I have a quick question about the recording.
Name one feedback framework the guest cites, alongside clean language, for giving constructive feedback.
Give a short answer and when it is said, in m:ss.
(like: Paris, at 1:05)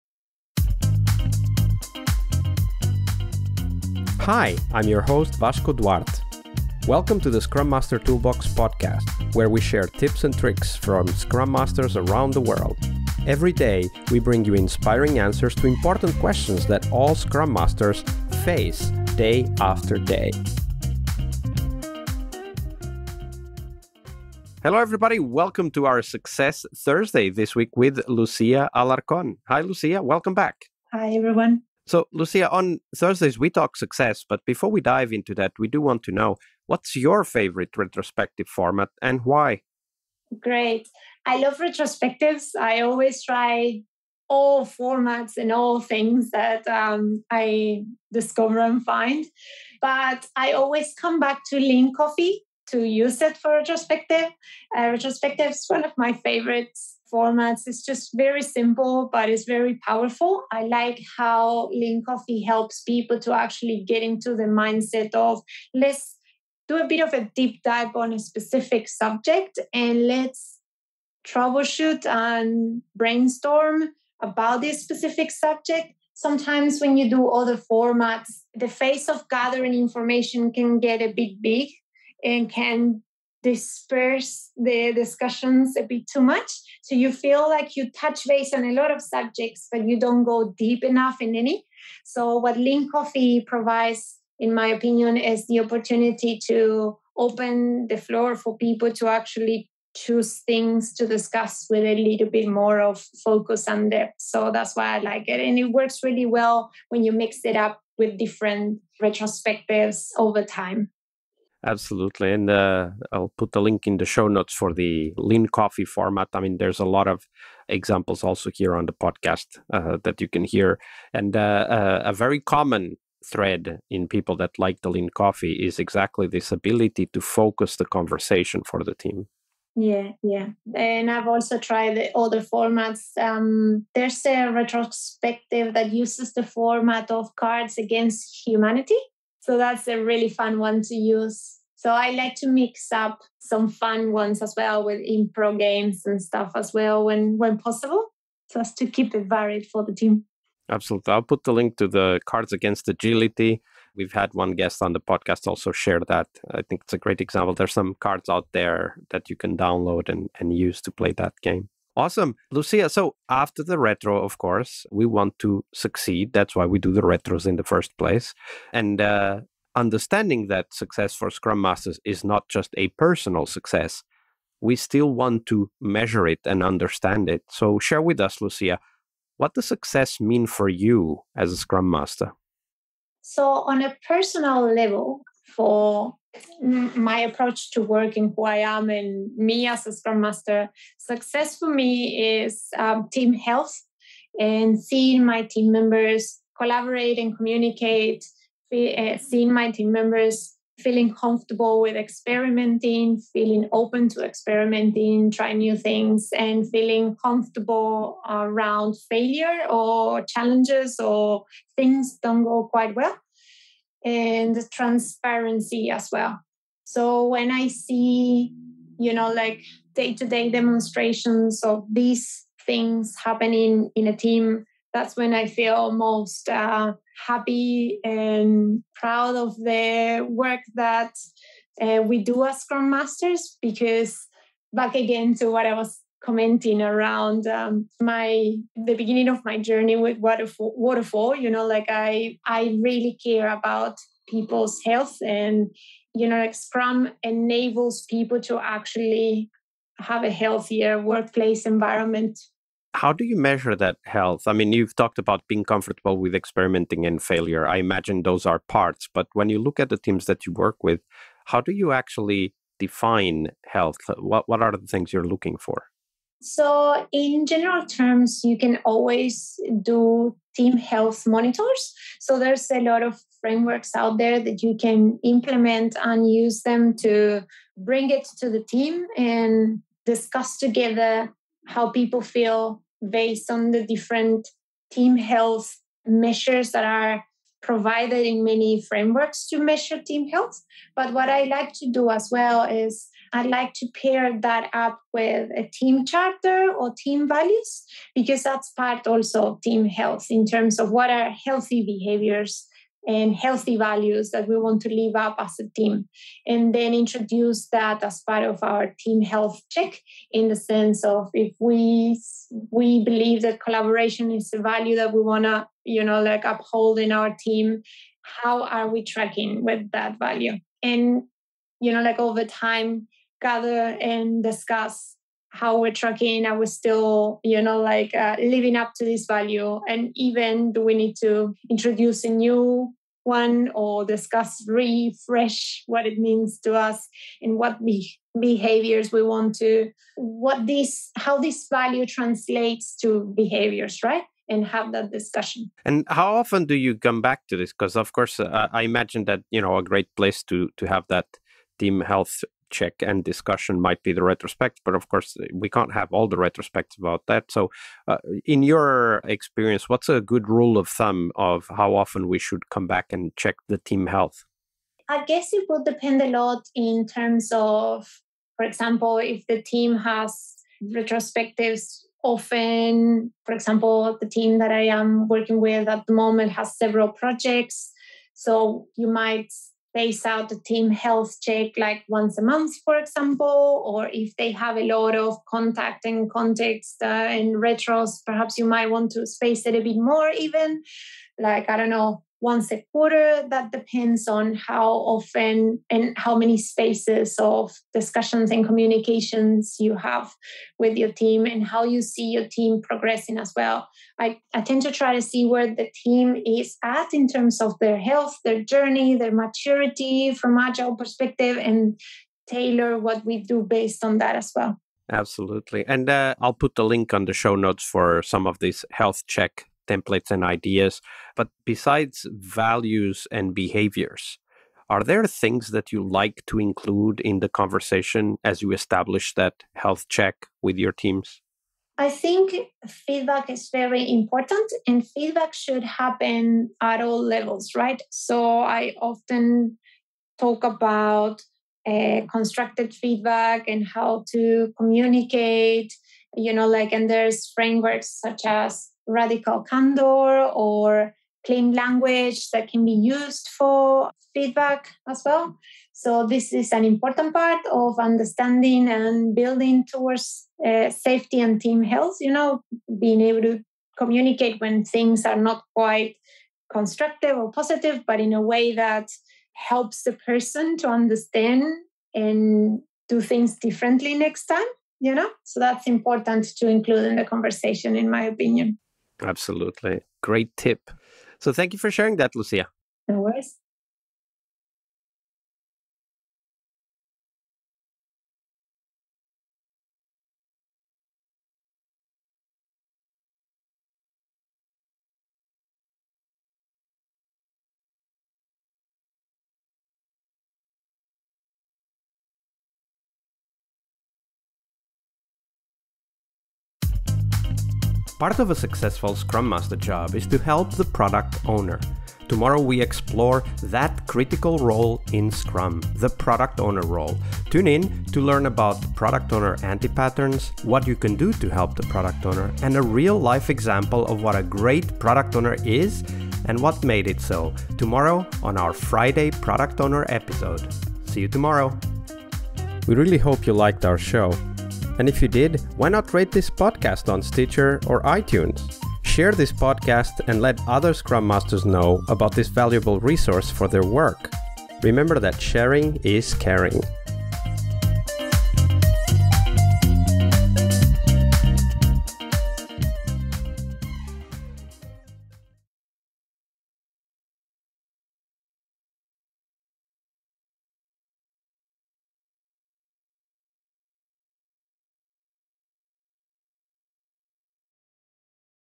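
Radical candor, at 7:29.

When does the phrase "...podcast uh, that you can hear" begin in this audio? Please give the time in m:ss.
1:58.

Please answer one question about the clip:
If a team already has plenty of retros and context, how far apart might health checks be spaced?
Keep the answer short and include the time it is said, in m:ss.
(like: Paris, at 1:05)
Once a quarter, at 6:32.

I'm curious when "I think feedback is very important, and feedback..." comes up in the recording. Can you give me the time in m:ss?
7:11.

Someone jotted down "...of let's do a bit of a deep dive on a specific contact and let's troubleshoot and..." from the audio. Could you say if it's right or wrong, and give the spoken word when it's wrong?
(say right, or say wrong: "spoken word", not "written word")
wrong: "subject", not "contact".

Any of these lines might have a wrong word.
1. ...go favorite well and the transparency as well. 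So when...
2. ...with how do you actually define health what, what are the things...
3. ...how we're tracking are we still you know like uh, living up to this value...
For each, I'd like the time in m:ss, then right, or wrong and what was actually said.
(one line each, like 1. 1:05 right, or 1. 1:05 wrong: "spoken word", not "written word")
1. 3:32 wrong: "quite", not "favorite"
2. 4:20 right
3. 5:25 right.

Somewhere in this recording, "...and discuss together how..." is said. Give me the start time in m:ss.
4:39.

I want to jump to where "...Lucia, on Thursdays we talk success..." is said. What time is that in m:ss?
0:32.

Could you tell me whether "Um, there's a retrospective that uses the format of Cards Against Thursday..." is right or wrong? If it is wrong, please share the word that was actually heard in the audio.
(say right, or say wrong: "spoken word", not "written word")
wrong: "Humanity", not "Thursday".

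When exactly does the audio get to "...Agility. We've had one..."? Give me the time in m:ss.
2:32.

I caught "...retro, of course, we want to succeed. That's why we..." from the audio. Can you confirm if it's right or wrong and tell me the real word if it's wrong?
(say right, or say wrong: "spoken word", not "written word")
right.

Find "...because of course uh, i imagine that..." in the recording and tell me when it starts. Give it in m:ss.
5:47.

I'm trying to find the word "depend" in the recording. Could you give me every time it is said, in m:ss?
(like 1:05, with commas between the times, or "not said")
6:05, 6:33.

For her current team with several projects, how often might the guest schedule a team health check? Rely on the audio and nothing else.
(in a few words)
Once a month.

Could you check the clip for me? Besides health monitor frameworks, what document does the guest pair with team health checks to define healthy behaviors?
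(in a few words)
Team charter.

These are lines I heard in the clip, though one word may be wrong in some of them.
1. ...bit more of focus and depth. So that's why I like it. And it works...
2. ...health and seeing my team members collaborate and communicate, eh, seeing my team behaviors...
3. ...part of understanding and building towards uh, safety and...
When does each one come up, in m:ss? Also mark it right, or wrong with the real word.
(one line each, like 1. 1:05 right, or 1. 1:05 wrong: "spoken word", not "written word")
1. 1:42 right
2. 3:13 wrong: "members", not "behaviors"
3. 7:37 right.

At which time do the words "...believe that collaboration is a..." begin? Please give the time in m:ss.
5:13.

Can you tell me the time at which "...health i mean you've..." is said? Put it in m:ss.
4:14.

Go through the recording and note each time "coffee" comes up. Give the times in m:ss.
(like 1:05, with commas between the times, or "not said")
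0:51, 1:02, 1:32, 1:55, 2:05.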